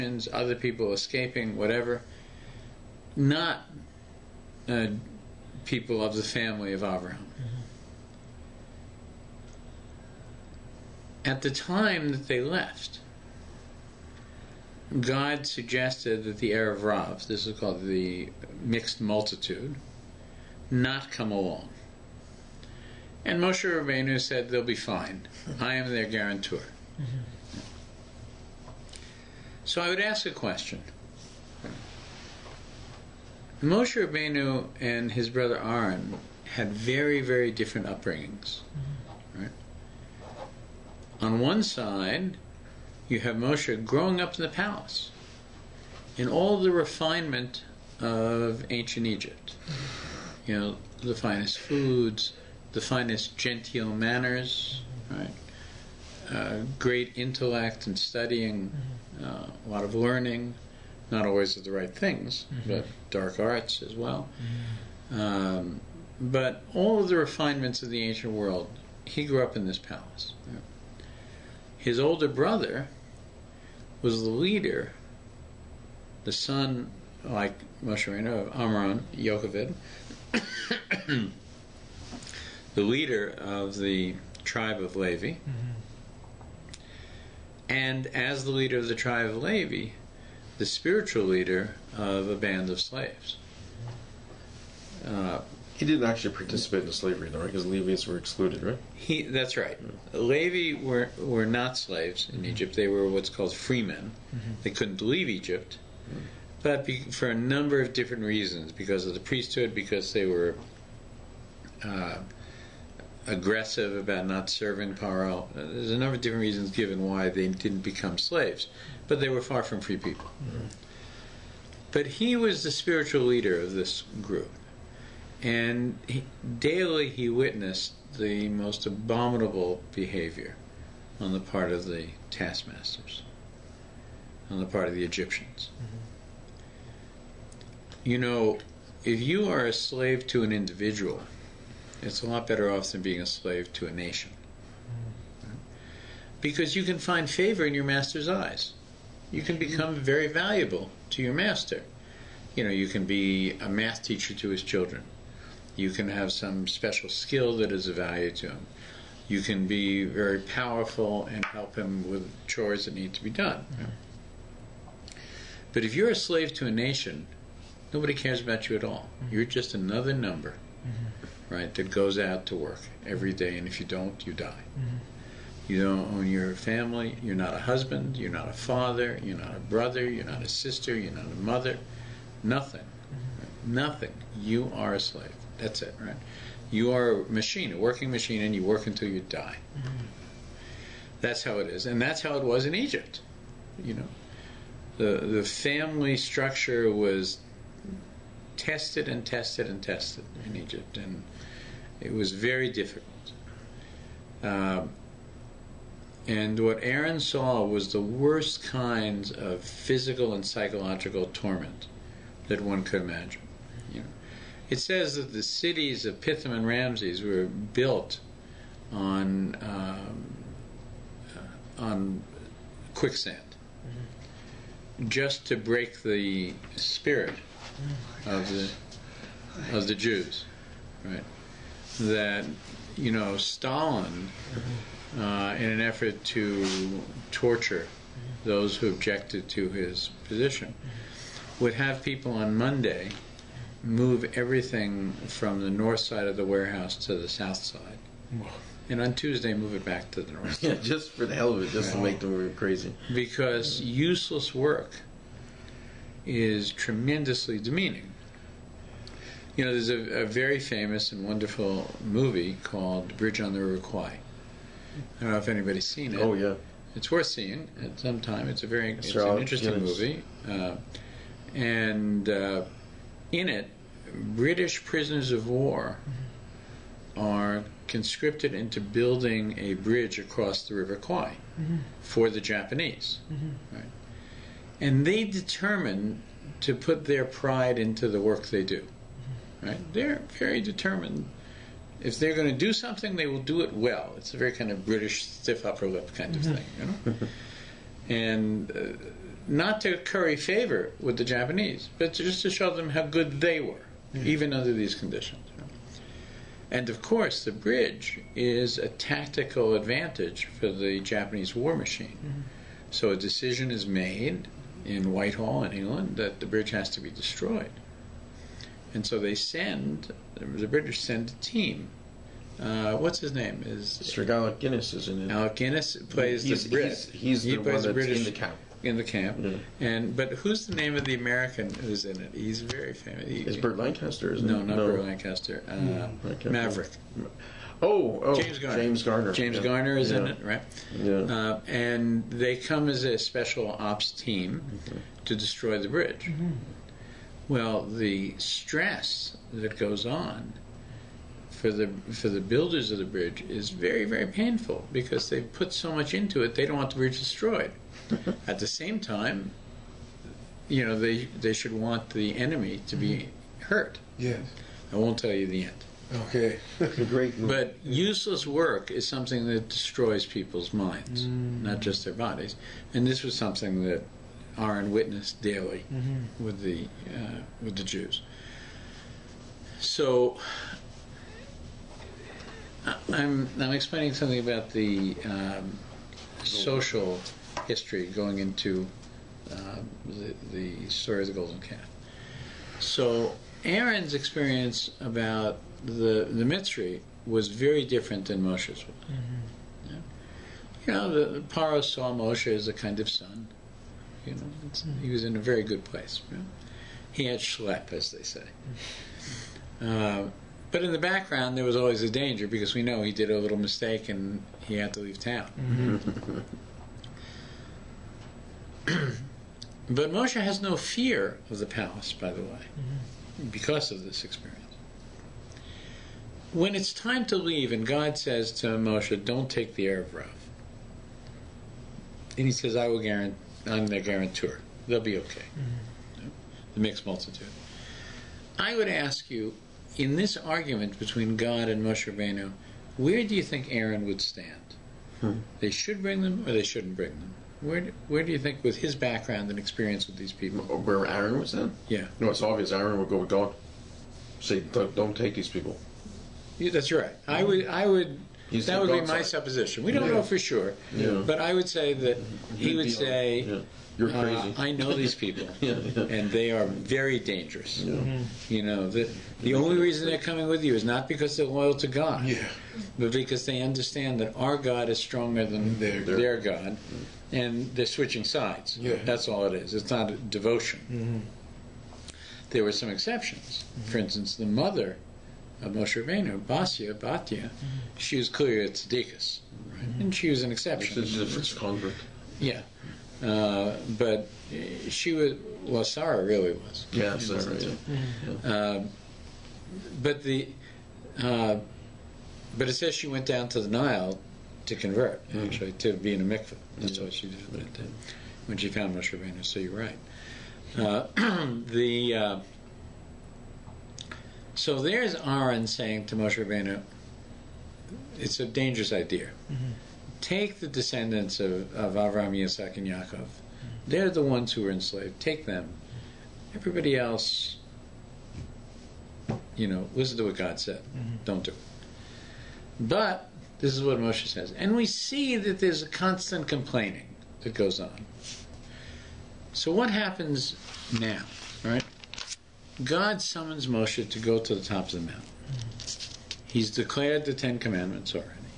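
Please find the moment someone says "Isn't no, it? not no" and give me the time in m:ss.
5:34.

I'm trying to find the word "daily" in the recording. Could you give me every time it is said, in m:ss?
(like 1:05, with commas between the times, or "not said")
2:06, 6:15.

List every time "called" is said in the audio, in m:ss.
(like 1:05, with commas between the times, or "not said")
0:17, 1:43, 4:22.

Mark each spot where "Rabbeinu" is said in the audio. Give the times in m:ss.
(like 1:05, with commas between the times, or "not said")
0:23, 0:34, 7:22, 8:06, 8:29, 8:36.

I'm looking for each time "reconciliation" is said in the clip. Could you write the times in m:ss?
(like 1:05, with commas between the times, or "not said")
not said.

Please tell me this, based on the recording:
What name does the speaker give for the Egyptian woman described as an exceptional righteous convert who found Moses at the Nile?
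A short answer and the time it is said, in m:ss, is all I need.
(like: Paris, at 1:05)
Batia, at 8:06.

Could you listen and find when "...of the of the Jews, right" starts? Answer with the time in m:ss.
3:48.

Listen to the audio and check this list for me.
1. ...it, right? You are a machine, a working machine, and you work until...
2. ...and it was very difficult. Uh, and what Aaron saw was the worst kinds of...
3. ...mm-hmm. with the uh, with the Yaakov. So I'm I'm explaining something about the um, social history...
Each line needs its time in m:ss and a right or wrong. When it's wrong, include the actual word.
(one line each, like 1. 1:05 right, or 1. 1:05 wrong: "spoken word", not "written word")
1. 3:05 right
2. 3:20 right
3. 6:15 wrong: "Jews", not "Yaakov".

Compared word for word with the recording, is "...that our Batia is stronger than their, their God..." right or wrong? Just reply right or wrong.
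wrong.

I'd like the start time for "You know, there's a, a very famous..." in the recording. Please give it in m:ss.
4:19.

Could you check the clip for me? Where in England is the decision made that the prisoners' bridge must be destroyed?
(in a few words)
Whitehall.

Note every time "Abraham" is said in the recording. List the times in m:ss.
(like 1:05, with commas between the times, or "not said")
0:06.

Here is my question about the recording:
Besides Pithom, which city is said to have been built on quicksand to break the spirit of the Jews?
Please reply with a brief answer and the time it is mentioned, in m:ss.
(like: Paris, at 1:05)
Ramses, at 3:36.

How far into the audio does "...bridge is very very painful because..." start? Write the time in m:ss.
5:53.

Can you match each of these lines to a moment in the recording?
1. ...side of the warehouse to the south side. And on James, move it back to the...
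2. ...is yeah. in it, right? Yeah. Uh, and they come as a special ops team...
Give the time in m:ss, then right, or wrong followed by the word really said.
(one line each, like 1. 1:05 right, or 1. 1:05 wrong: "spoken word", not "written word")
1. 4:05 wrong: "Tuesday", not "James"
2. 5:39 right.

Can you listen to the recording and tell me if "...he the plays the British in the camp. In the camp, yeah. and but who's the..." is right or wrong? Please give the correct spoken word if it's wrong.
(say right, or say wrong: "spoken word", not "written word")
right.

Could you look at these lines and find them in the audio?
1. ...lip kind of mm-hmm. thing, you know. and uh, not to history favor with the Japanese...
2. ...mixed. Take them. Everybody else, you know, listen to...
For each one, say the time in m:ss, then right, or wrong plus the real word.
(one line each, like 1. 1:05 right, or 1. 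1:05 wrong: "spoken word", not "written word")
1. 4:55 wrong: "curry", not "history"
2. 8:44 wrong: "enslaved", not "mixed".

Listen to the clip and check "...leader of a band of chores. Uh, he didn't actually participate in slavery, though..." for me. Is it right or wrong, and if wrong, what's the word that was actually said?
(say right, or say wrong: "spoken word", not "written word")
wrong: "slaves", not "chores".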